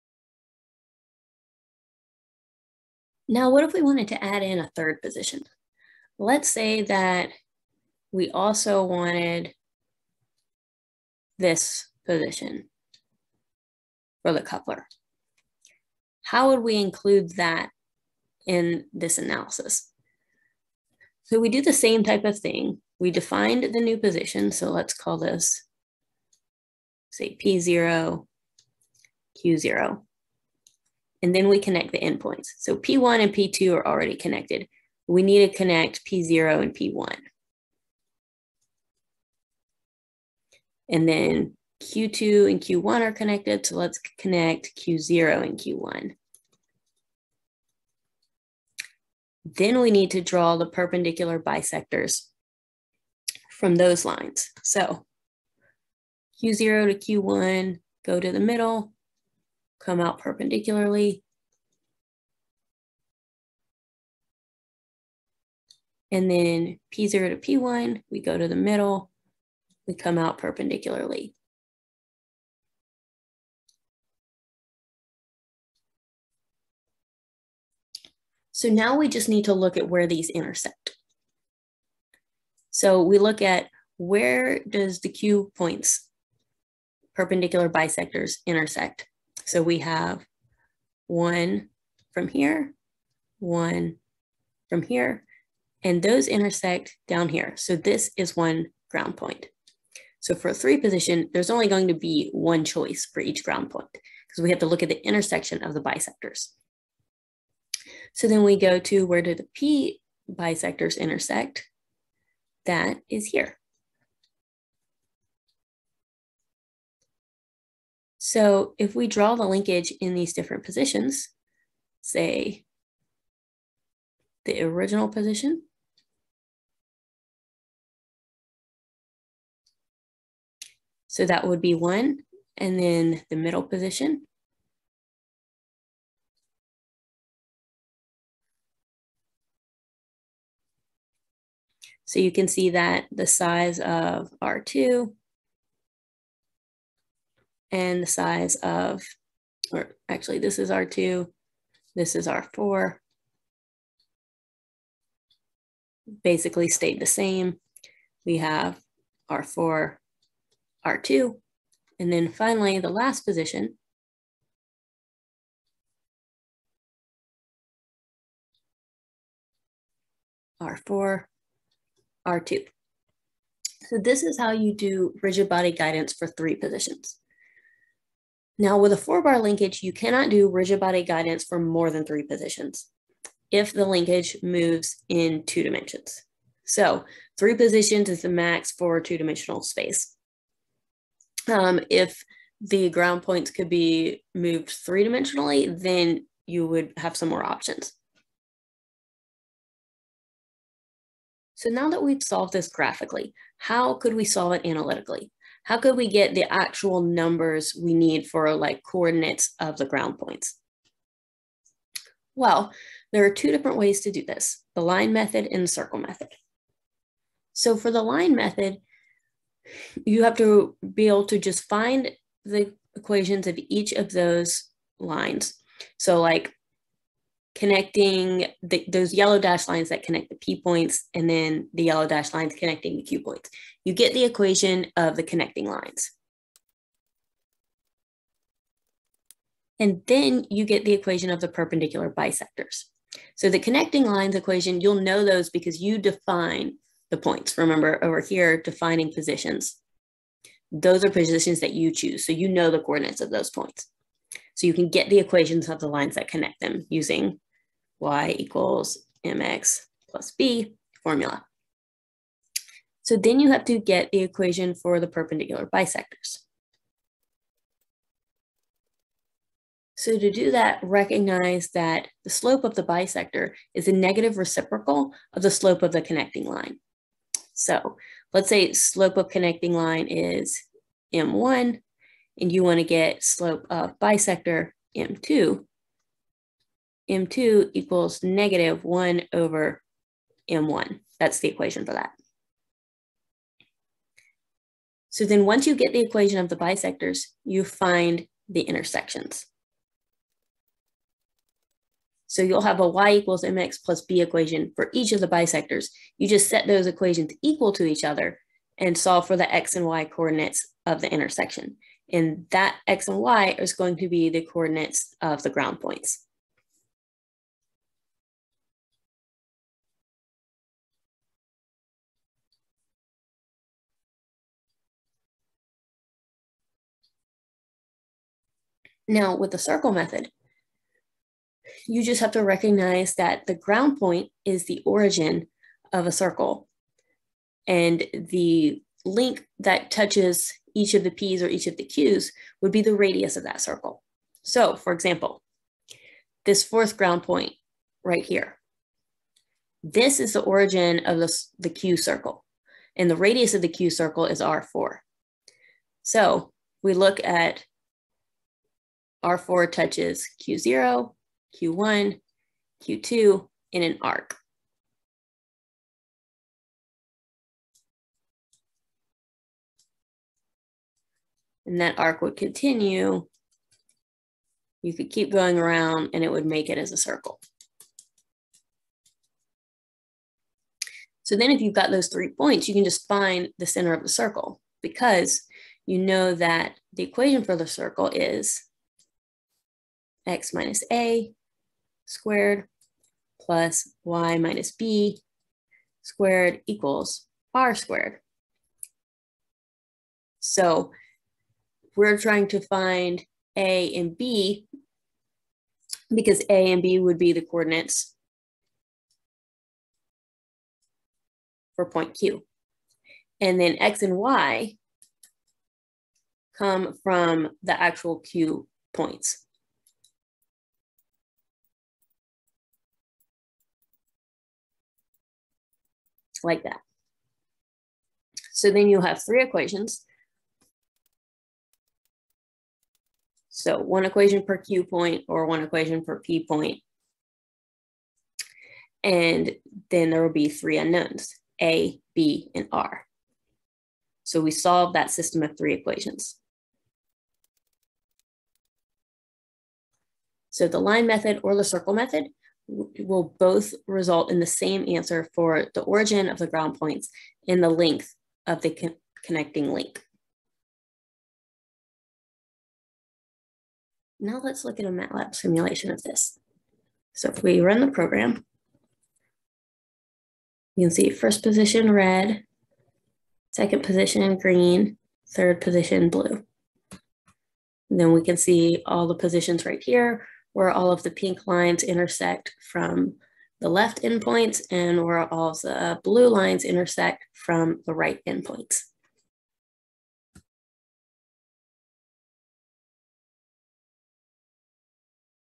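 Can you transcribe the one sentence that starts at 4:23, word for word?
So then you have to get the equation for the perpendicular bisectors.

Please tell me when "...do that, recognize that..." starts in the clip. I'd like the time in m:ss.
4:30.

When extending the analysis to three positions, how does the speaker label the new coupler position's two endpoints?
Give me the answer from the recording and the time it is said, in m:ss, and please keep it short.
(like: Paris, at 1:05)
P0, Q0, at 0:27.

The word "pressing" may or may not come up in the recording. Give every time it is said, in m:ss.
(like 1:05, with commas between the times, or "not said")
not said.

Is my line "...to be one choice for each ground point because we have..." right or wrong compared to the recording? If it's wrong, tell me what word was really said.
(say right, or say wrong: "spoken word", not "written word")
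right.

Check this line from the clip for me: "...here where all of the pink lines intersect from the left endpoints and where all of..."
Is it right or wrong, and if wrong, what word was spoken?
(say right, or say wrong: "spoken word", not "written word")
right.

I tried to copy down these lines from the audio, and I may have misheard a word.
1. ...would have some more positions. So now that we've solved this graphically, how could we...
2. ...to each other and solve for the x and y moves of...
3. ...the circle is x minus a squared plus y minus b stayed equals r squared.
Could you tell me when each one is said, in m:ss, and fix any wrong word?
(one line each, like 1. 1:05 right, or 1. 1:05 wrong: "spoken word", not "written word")
1. 3:16 wrong: "options", not "positions"
2. 5:07 wrong: "coordinates", not "moves"
3. 6:27 wrong: "squared", not "stayed".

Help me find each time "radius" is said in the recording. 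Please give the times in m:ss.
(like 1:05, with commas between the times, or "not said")
5:42, 5:53.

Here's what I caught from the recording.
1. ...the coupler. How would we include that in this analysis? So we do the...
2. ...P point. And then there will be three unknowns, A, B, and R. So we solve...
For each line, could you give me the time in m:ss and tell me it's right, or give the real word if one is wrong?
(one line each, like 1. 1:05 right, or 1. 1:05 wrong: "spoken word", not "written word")
1. 0:14 right
2. 7:16 right.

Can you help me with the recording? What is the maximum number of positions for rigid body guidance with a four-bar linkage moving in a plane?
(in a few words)
3.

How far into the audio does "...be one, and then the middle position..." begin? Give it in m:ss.
2:11.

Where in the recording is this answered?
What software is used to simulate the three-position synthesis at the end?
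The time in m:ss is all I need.
7:44.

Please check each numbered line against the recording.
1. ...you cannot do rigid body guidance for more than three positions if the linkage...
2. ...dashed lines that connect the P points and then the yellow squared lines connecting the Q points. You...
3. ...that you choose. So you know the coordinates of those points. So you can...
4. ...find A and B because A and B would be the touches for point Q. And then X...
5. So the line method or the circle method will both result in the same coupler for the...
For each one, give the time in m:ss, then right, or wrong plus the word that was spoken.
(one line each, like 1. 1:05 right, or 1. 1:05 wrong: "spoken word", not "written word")
1. 2:59 right
2. 3:49 wrong: "dashed", not "squared"
3. 4:11 right
4. 6:42 wrong: "coordinates", not "touches"
5. 7:30 wrong: "answer", not "coupler".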